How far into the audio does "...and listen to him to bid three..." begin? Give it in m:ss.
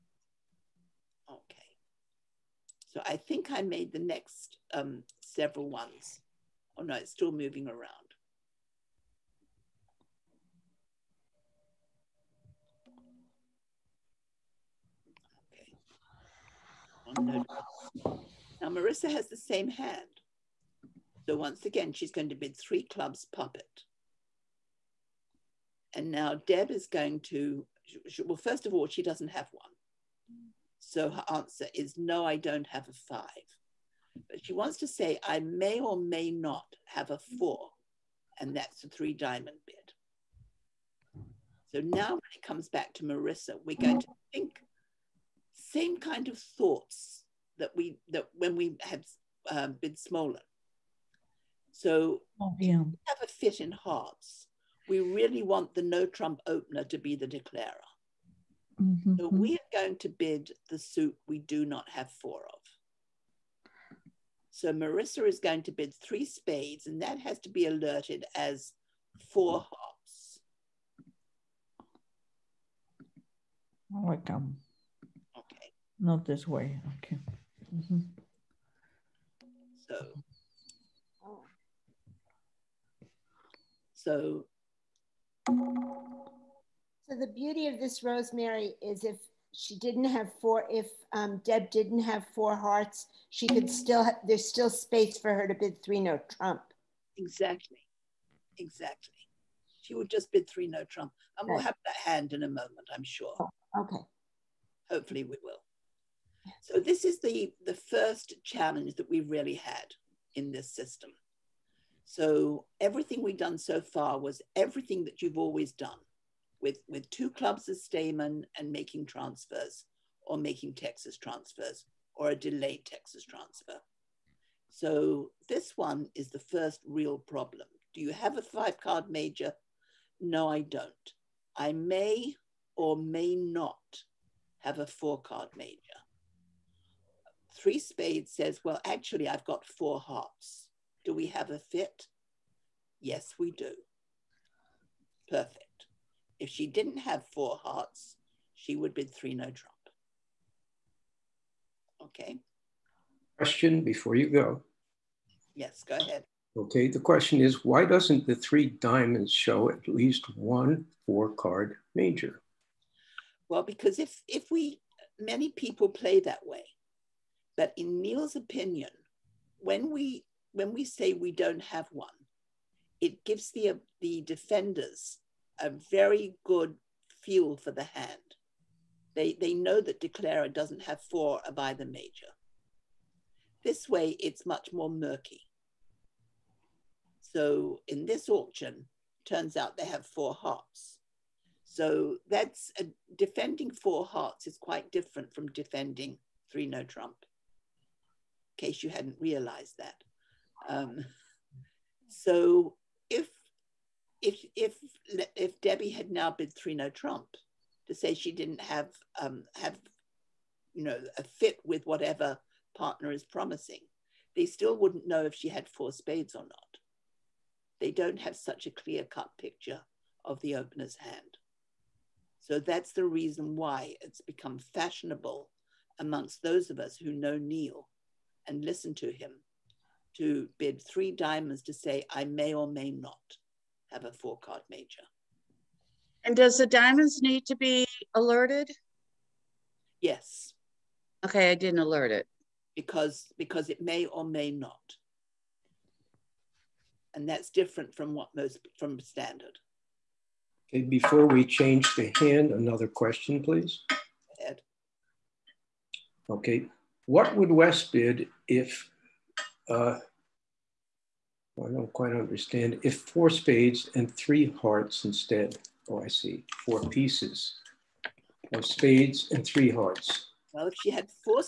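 3:48.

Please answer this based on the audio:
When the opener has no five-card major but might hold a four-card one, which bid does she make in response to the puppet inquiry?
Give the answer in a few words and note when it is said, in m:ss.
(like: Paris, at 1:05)
3 diamonds, at 0:38.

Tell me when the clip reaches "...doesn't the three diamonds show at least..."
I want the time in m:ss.
2:37.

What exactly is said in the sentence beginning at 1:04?
So Marissa is going to bid three spades, and that has to be alerted as four hearts.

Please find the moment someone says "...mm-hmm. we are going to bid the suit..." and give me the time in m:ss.
0:59.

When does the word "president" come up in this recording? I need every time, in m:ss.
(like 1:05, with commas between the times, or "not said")
not said.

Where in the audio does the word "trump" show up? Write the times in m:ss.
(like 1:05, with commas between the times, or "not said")
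0:56, 1:36, 1:40, 2:29, 3:16, 3:26.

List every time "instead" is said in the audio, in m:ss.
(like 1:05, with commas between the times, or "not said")
4:25.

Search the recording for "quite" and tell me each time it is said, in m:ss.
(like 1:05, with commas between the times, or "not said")
3:14, 4:21.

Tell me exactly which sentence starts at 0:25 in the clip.
And now Deb is going to, well, first of all, she doesn't have one.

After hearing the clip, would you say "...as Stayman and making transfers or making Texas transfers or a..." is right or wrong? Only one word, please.
right.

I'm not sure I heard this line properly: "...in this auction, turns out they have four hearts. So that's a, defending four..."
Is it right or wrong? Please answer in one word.
right.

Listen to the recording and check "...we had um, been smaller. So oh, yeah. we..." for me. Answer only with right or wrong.
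right.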